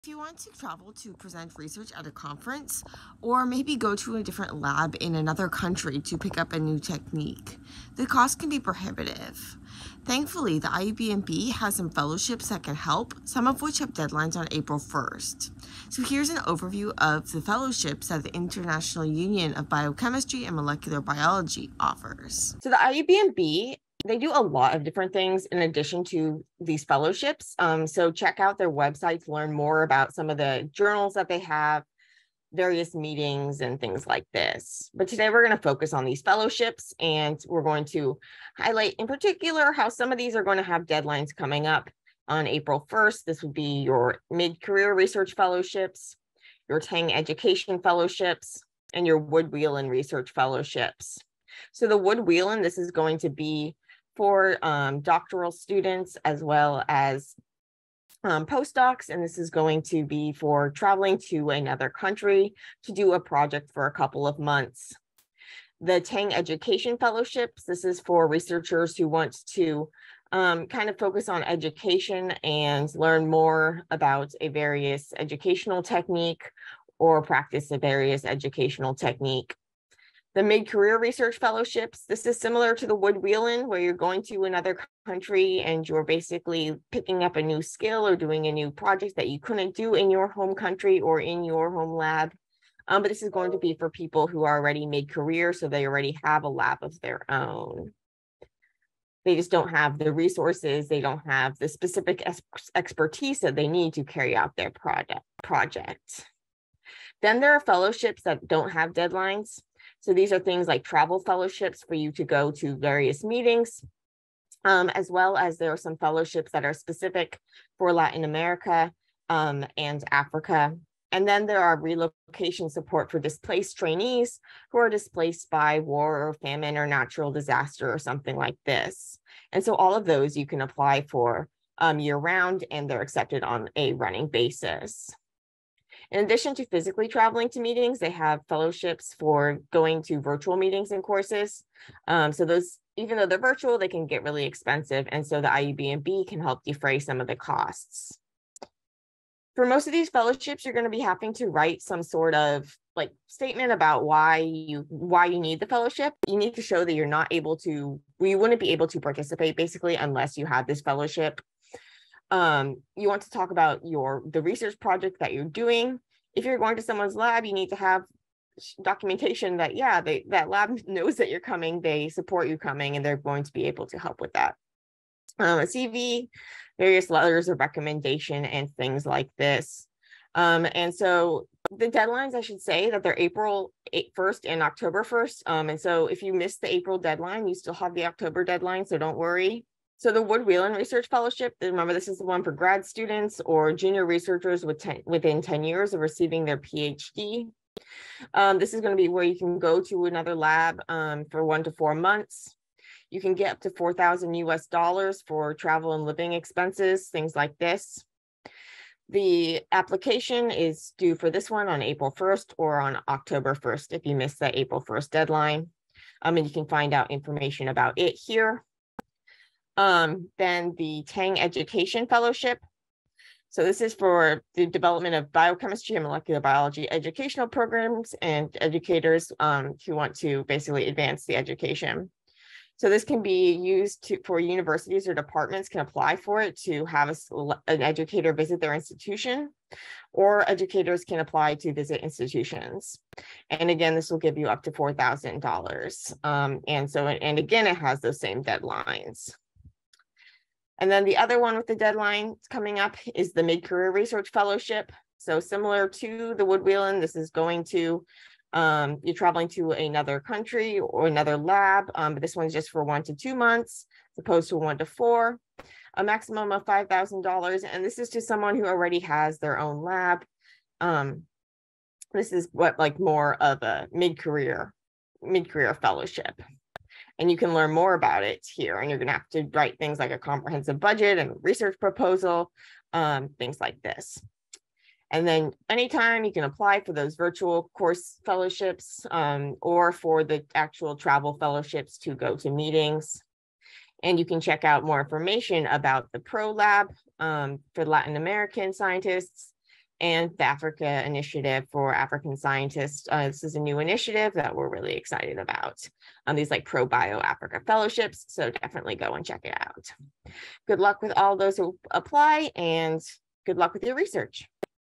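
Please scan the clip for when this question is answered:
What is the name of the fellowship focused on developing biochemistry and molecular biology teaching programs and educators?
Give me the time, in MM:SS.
03:41.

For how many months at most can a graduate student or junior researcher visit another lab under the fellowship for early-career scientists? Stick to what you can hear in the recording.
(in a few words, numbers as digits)
4.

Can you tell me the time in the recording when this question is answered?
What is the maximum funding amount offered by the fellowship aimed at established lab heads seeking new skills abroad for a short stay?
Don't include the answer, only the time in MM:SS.
04:25.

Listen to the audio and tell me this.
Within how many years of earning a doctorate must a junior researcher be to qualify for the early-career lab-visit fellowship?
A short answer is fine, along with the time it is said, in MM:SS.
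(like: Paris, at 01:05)
10 years, at 03:15.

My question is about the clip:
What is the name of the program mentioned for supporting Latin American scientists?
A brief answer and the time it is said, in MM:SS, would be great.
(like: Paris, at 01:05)
Pro Lab, at 04:56.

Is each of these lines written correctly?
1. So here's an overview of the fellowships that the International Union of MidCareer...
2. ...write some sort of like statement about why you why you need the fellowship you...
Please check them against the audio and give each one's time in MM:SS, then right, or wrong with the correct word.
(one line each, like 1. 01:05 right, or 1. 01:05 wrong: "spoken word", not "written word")
1. 00:15 wrong: "Biochemistry", not "MidCareer"
2. 02:31 right.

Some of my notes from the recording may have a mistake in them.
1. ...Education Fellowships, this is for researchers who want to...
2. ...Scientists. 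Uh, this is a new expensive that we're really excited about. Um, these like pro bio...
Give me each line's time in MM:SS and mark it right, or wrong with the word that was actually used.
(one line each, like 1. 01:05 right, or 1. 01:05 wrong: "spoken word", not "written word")
1. 01:06 right
2. 05:02 wrong: "initiative", not "expensive".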